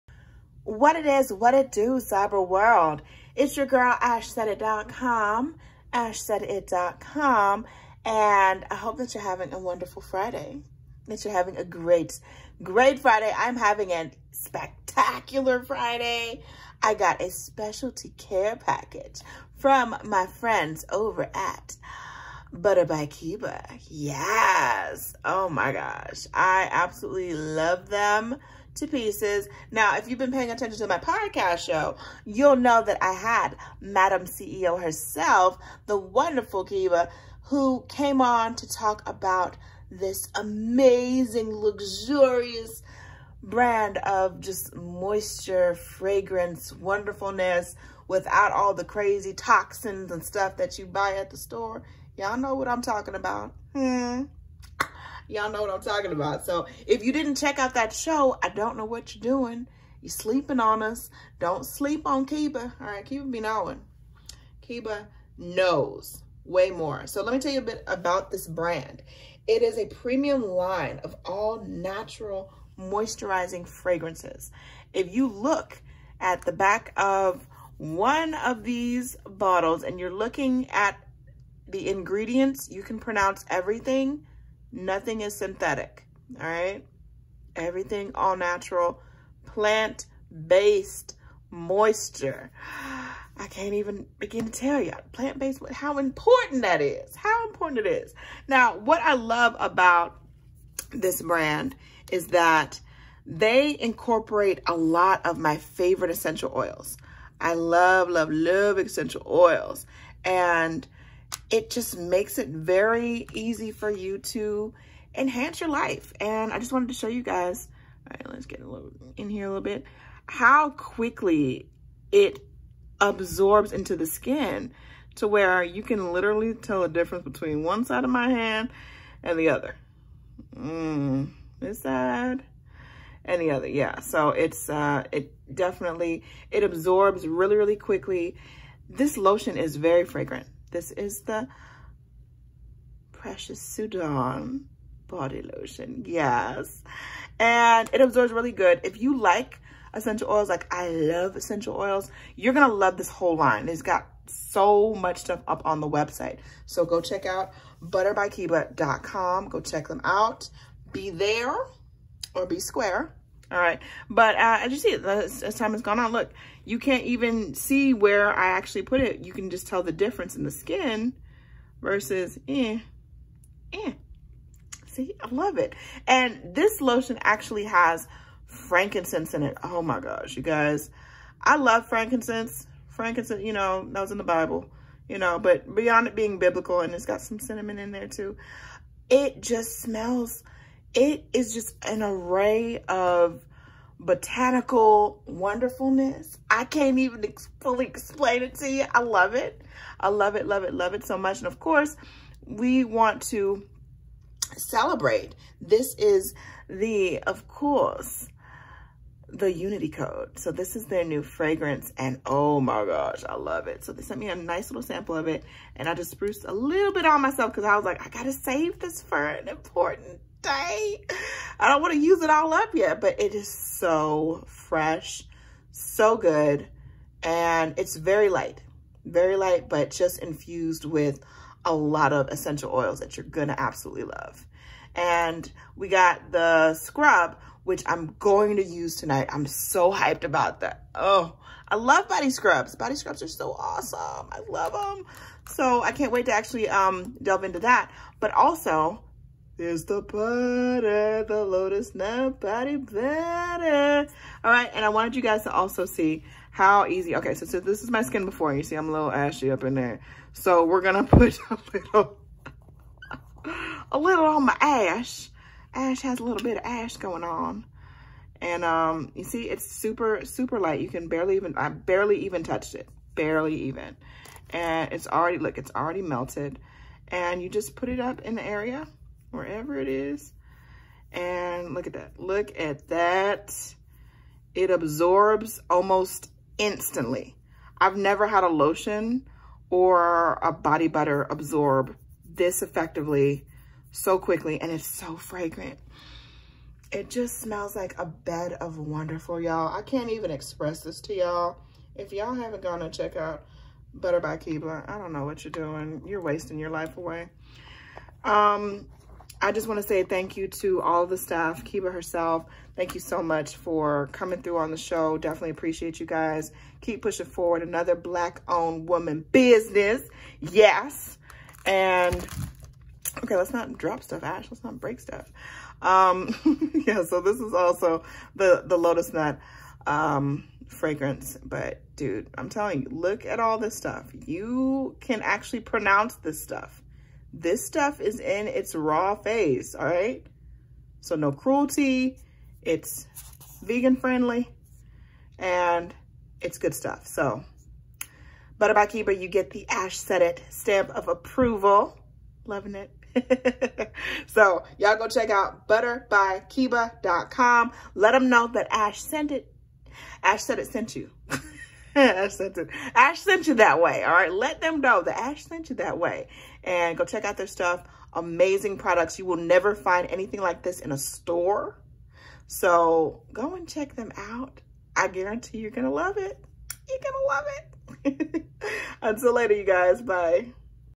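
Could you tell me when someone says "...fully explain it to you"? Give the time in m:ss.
3:17.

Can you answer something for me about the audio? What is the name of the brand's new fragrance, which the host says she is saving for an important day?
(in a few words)
Unity Code.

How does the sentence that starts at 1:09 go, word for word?
It is a premium line of all natural moisturizing fragrances.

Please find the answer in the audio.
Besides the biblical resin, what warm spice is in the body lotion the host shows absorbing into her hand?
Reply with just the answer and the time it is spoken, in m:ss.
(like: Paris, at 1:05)
Cinnamon, at 3:07.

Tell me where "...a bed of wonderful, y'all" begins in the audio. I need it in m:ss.
4:57.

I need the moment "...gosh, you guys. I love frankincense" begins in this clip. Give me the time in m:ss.
2:59.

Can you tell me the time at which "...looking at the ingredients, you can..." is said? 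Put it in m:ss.
1:20.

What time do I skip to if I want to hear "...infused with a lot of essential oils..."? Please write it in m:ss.
3:50.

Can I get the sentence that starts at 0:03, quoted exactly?
It's your girl, AshSaidIt.com, AshSaidIt.com, and I hope that you're having a wonderful Friday, that you're having a great, great Friday.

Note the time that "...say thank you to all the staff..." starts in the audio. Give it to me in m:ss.
5:09.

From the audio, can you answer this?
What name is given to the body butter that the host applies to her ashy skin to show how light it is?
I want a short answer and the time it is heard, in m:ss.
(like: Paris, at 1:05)
Lotus Nut, at 5:28.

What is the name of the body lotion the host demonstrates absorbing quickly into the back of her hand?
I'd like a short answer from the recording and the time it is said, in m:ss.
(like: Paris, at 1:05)
Precious Sudan, at 2:23.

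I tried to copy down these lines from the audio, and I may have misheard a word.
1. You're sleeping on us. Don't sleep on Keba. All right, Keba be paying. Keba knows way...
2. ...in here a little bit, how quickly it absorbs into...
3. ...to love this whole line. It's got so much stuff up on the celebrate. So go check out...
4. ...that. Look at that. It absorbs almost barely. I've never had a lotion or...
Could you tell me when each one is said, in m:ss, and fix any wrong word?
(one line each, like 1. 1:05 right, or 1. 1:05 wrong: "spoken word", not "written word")
1. 1:00 wrong: "knowing", not "paying"
2. 1:59 right
3. 2:32 wrong: "website", not "celebrate"
4. 4:41 wrong: "instantly", not "barely".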